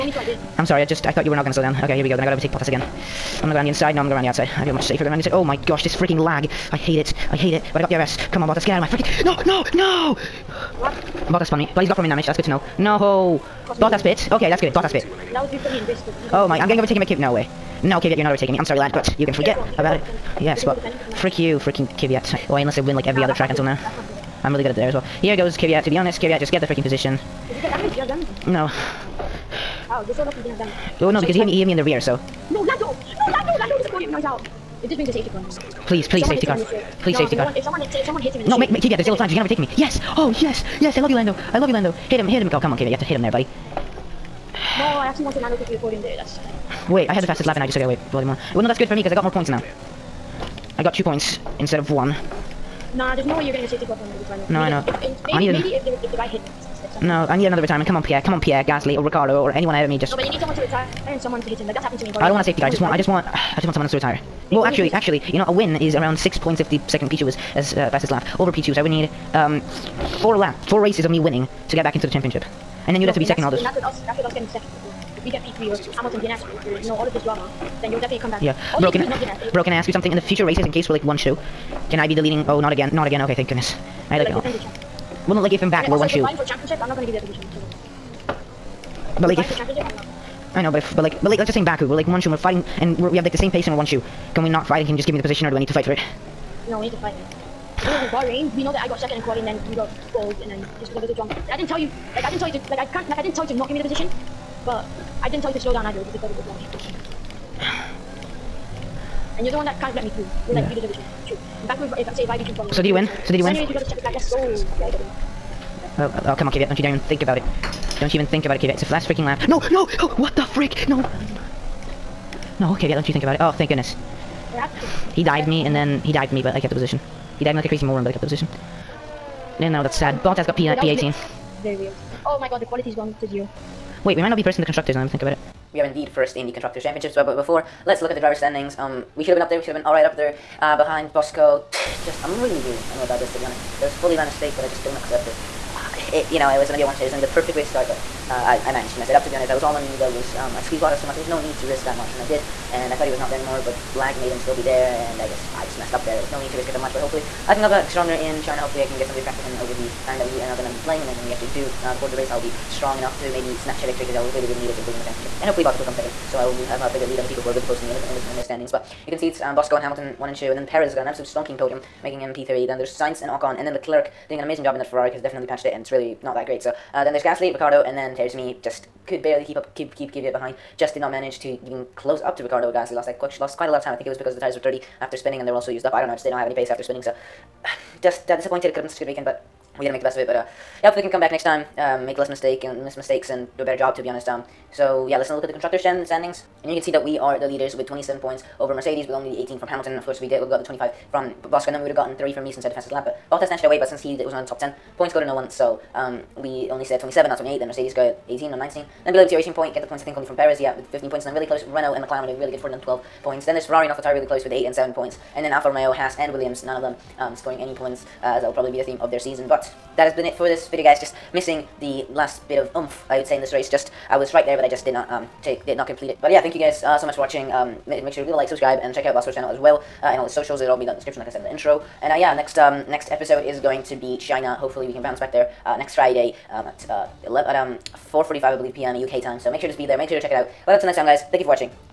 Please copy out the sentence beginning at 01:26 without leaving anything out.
Fighting for championship, I'm not gonna give you a position.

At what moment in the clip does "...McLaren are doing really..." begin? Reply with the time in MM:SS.
03:32.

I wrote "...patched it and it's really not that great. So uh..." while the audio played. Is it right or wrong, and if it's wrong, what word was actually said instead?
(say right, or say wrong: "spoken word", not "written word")
right.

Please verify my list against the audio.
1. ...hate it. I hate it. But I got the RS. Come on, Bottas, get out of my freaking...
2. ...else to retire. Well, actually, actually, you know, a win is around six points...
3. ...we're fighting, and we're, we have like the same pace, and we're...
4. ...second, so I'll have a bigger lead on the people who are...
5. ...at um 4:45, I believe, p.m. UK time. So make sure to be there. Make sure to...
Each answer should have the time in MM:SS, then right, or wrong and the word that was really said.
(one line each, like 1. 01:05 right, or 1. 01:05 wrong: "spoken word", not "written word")
1. 00:06 right
2. 01:03 right
3. 01:32 right
4. 02:45 right
5. 03:57 right.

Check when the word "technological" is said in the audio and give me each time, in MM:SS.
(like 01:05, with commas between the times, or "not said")
not said.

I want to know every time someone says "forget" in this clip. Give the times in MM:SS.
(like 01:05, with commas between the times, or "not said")
00:19.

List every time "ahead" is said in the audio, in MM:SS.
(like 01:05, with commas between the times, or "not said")
00:59.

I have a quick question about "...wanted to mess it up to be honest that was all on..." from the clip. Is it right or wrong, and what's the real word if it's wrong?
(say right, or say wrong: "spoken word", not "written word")
wrong: "managed", not "wanted".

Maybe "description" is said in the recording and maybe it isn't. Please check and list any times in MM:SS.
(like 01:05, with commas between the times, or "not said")
03:50.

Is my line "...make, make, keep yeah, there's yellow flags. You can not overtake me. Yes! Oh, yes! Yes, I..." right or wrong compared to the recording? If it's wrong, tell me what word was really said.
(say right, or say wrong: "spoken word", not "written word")
right.